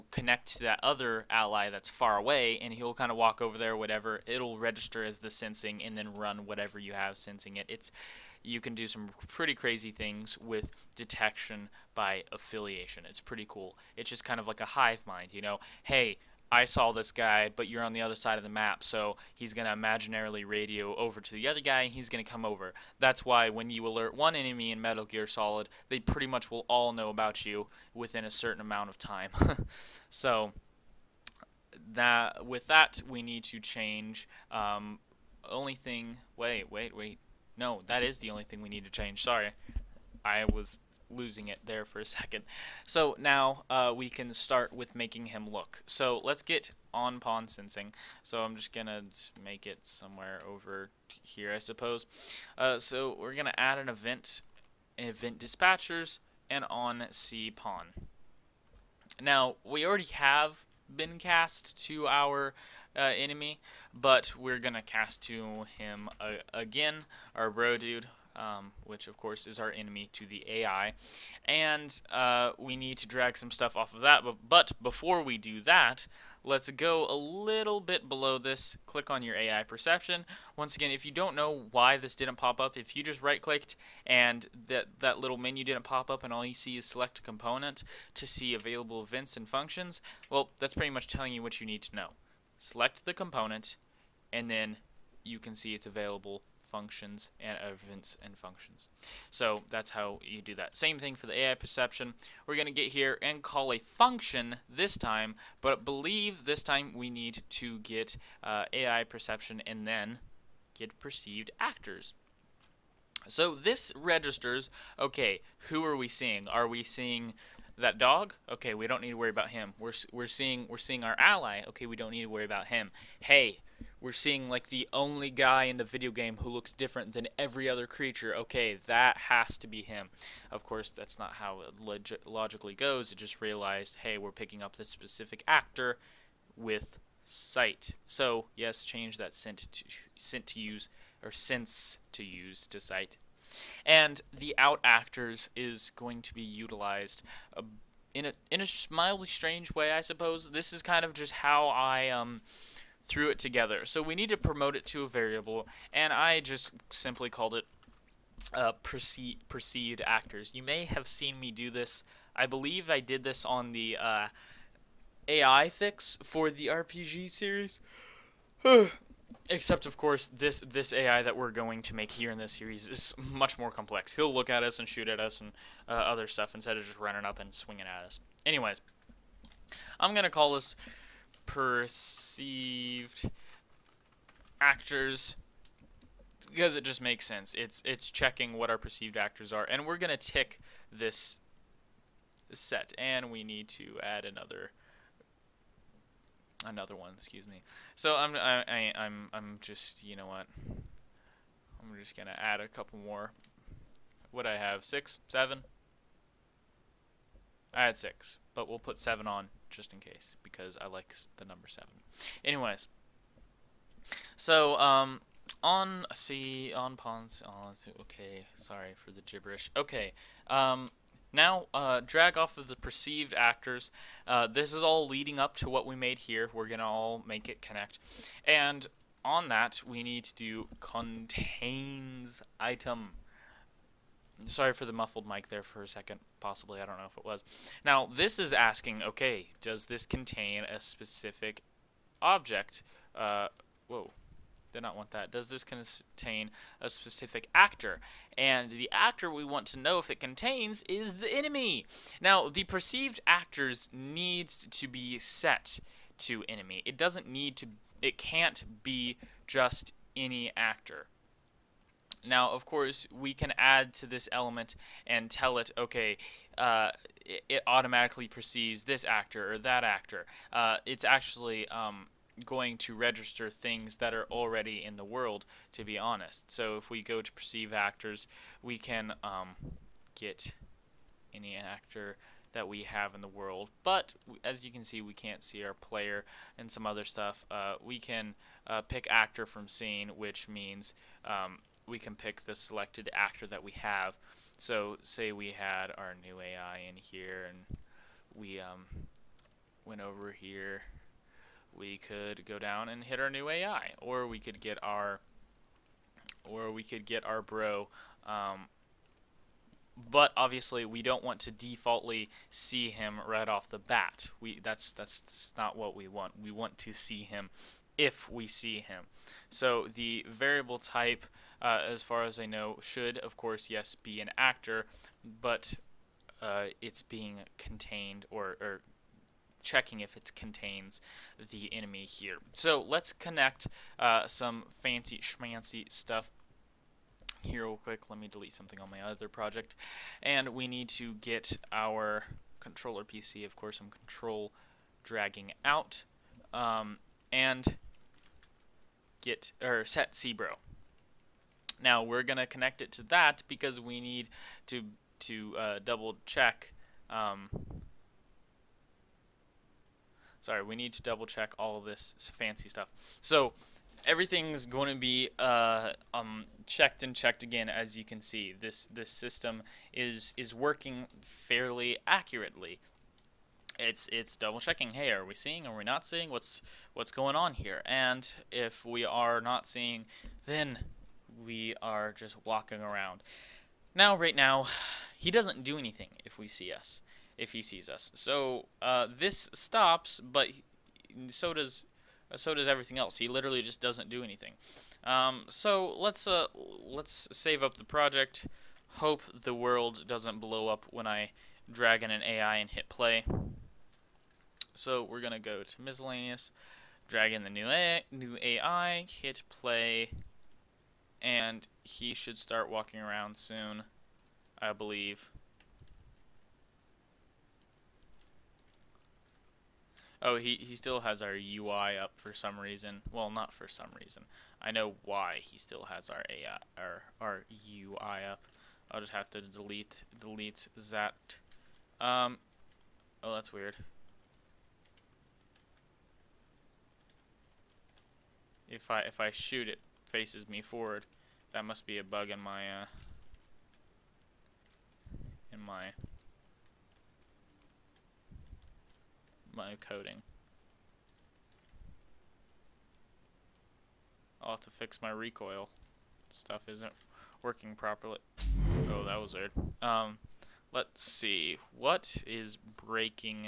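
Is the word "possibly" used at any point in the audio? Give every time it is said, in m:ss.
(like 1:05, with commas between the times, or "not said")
3:56.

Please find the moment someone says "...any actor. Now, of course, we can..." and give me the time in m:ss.
4:20.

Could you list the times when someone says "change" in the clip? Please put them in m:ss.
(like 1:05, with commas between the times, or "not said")
0:33, 0:38, 2:18.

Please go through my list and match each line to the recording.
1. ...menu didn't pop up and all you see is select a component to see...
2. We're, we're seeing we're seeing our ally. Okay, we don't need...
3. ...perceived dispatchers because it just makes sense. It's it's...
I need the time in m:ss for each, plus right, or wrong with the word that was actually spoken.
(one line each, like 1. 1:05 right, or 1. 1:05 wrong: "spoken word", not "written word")
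1. 1:25 right
2. 1:59 right
3. 3:01 wrong: "actors", not "dispatchers".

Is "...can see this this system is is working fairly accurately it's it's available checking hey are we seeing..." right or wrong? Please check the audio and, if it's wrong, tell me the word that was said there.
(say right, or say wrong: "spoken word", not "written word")
wrong: "double", not "available".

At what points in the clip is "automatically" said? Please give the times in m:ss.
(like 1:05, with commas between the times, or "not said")
4:27.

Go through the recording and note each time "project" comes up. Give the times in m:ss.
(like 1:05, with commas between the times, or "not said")
5:39, 6:37.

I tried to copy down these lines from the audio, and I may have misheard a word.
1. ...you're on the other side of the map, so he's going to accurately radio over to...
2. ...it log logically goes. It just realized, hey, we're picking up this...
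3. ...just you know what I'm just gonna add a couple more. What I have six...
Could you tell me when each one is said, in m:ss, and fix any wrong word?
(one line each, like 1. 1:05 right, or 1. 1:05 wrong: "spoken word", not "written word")
1. 0:17 wrong: "imaginarily", not "accurately"
2. 2:11 right
3. 3:19 right.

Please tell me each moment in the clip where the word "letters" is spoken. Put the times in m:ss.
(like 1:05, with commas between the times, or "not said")
not said.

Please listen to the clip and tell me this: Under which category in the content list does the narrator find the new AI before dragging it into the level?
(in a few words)
Miscellaneous.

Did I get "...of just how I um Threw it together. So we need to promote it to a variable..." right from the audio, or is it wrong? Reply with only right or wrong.
right.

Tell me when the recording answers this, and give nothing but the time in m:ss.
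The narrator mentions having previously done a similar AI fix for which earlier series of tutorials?
2:46.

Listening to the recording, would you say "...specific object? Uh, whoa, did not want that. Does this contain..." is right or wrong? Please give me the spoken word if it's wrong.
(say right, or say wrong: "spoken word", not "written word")
right.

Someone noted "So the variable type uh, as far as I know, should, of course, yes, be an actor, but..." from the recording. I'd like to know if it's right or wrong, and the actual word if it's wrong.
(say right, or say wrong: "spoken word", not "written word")
right.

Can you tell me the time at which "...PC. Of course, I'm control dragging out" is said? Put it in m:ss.
5:43.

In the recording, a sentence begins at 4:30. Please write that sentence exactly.
Uh, it's actually um, going to register things that are already in the world, to be honest.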